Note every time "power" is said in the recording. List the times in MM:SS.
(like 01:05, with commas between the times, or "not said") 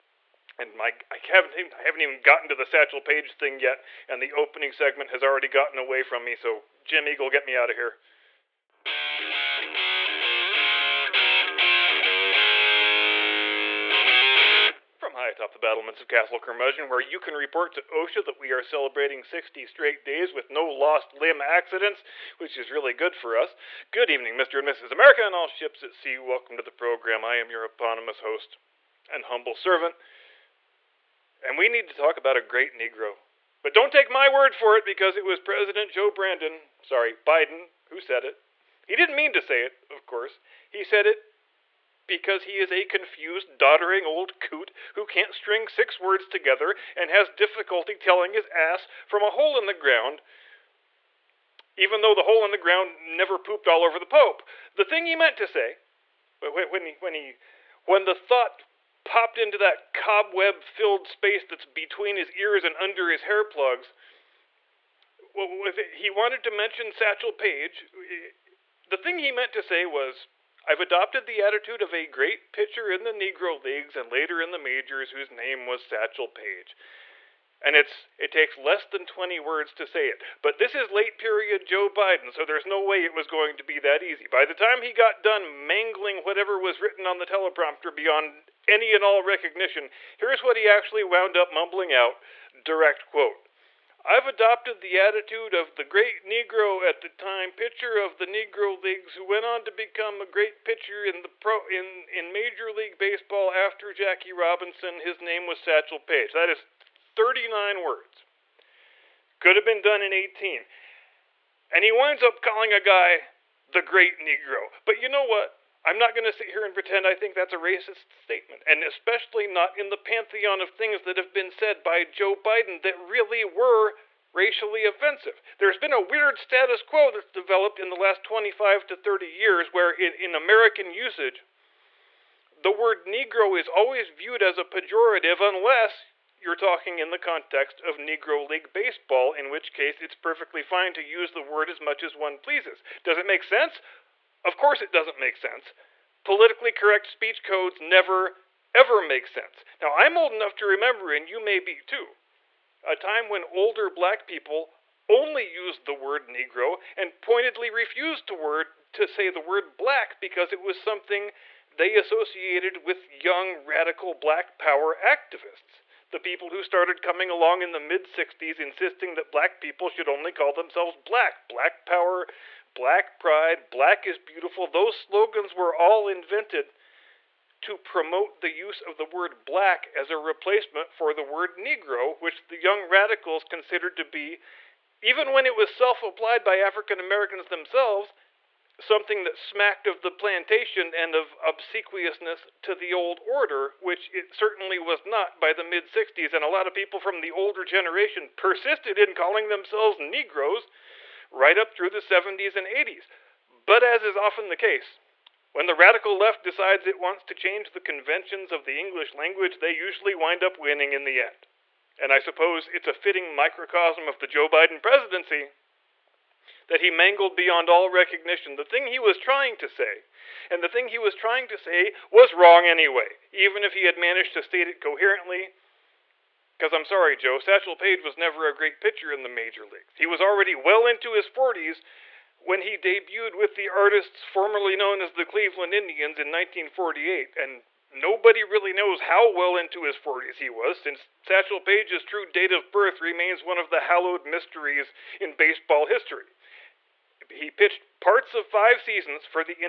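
02:44, 02:51.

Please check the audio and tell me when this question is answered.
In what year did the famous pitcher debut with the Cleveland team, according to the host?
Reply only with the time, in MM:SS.
03:56.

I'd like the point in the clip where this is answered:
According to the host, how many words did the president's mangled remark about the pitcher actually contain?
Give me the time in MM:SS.
01:46.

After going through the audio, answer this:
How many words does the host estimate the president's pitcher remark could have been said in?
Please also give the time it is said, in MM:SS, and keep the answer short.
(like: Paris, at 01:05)
18, at 01:50.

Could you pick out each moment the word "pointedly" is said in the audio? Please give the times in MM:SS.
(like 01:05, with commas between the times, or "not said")
02:37.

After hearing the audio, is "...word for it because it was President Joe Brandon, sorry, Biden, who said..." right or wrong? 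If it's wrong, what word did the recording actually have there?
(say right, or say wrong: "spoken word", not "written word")
right.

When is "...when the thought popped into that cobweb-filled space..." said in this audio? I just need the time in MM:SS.
00:57.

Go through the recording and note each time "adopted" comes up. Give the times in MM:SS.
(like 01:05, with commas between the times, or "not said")
01:10, 01:34.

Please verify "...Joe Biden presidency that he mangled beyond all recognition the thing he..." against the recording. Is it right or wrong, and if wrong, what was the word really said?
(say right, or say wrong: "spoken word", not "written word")
right.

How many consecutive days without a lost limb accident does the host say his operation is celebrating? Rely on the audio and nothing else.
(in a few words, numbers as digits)
60.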